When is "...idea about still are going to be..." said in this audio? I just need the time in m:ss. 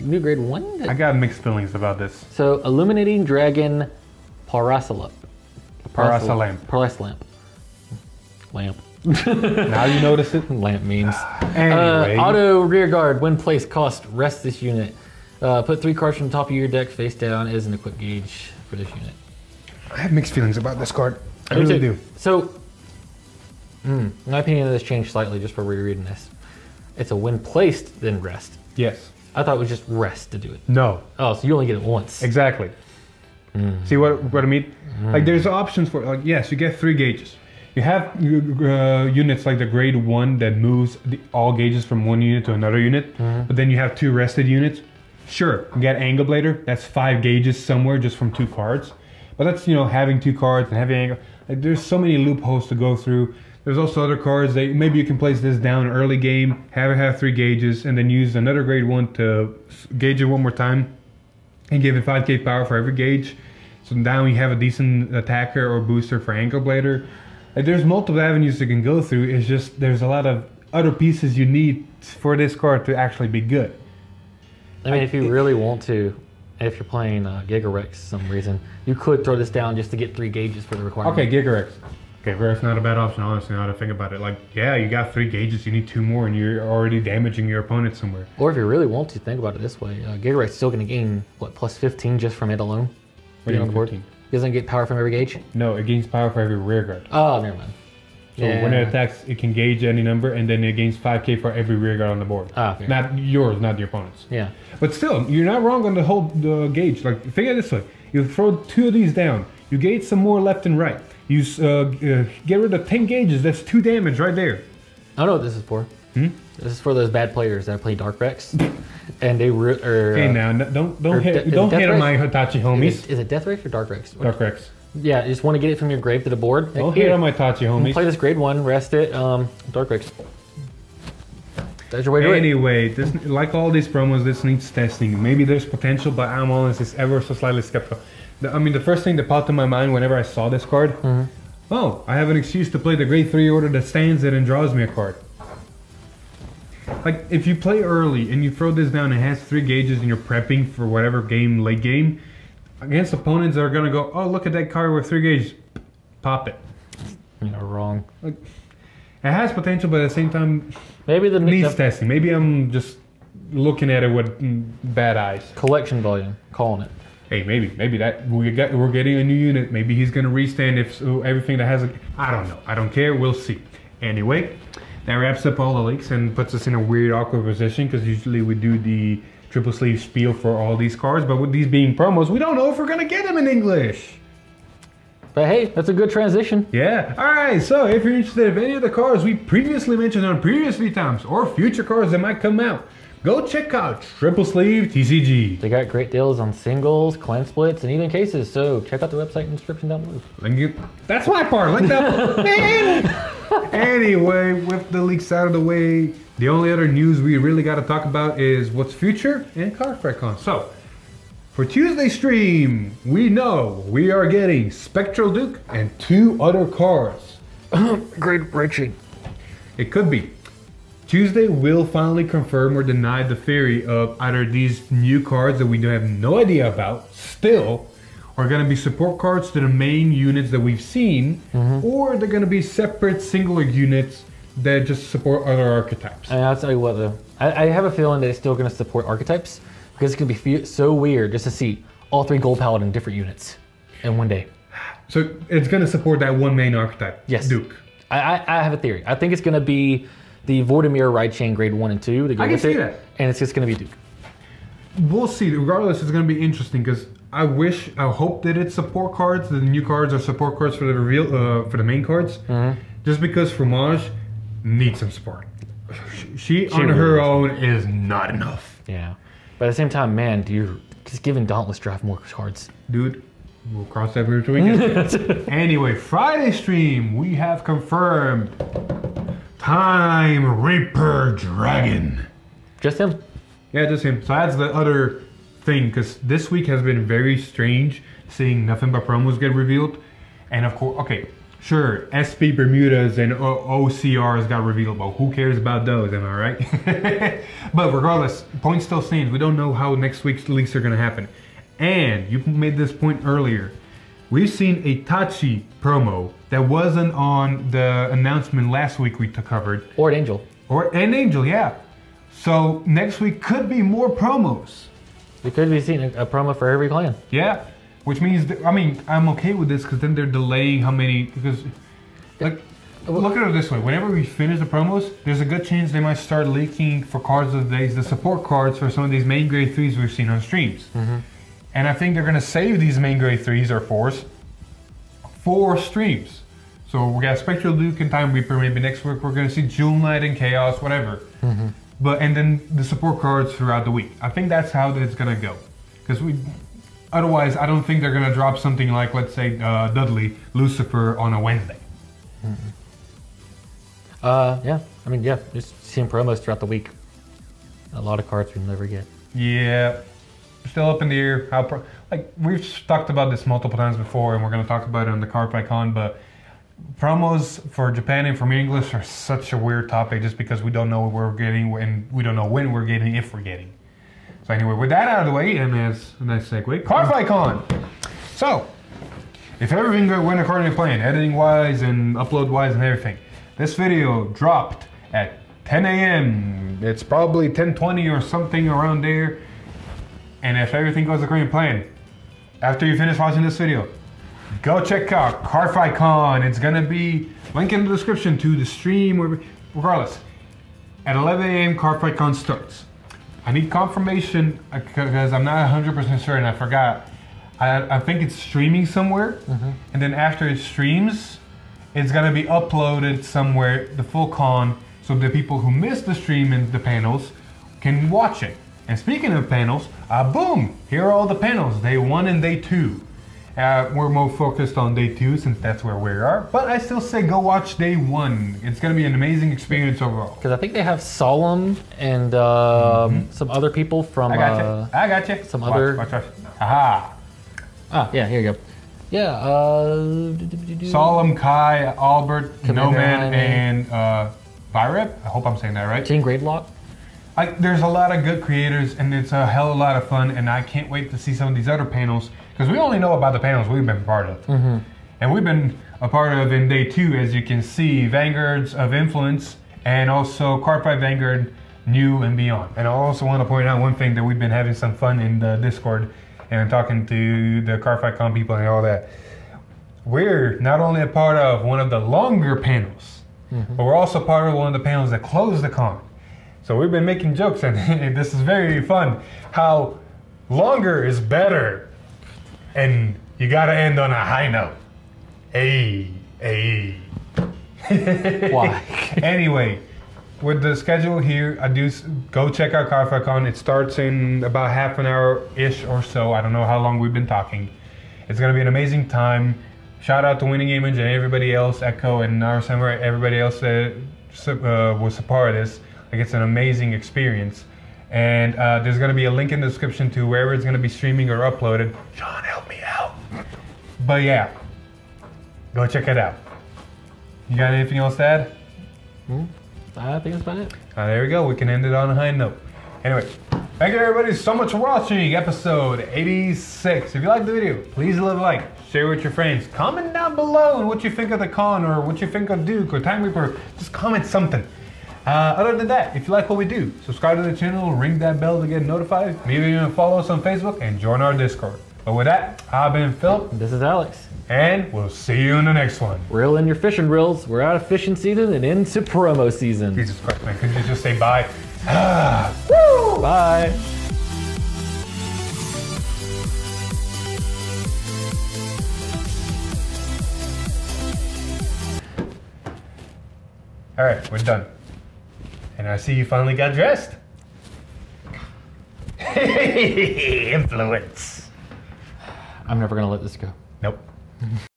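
3:46.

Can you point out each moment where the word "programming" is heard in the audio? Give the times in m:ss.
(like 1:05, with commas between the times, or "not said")
not said.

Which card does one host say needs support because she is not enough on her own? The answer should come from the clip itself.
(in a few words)
Fromage.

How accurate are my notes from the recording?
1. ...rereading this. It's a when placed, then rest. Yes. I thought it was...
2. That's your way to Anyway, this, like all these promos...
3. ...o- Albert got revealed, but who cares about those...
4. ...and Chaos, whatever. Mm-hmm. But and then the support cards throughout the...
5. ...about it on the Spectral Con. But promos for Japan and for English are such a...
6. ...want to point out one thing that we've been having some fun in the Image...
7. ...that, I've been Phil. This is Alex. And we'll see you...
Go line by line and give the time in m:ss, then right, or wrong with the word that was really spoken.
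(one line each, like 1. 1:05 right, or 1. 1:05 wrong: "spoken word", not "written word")
1. 0:25 right
2. 2:11 right
3. 4:53 wrong: "OCRs", not "Albert"
4. 5:40 right
5. 6:04 wrong: "Cardfight", not "Spectral"
6. 7:43 wrong: "Discord", not "Image"
7. 9:02 right.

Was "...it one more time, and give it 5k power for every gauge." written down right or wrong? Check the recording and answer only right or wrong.
right.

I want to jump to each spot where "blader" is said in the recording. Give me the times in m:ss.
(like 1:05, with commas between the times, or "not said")
0:46, 1:06.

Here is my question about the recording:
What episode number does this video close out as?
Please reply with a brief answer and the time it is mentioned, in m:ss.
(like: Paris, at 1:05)
86, at 8:45.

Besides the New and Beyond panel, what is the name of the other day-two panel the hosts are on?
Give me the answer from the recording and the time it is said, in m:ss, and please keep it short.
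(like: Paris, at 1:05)
Vanguards of Influence, at 7:38.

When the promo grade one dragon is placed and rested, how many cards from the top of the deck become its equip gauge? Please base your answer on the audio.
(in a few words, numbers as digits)
3.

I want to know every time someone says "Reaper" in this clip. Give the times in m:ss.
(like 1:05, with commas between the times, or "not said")
4:40, 5:38, 8:53.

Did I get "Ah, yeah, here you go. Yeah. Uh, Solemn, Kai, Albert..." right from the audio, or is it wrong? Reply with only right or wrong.
right.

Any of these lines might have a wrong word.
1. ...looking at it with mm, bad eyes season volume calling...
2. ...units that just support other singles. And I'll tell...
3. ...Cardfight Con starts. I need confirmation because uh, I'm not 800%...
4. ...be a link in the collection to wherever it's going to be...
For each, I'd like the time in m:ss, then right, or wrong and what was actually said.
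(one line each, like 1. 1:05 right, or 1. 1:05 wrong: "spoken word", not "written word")
1. 2:43 wrong: "collection", not "season"
2. 3:53 wrong: "archetypes", not "singles"
3. 6:41 wrong: "100", not "800"
4. 8:29 wrong: "description", not "collection".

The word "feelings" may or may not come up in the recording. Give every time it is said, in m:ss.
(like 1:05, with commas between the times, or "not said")
0:01, 0:20, 3:57.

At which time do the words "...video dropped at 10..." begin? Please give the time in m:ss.
6:23.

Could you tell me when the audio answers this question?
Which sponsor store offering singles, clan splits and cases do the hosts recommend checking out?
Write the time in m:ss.
3:14.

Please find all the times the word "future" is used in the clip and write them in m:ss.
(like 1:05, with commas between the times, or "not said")
3:11, 3:28.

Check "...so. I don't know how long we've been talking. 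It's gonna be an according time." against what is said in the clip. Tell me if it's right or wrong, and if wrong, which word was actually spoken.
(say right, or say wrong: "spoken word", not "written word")
wrong: "amazing", not "according".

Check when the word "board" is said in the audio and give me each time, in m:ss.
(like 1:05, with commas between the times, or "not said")
1:42, 2:06.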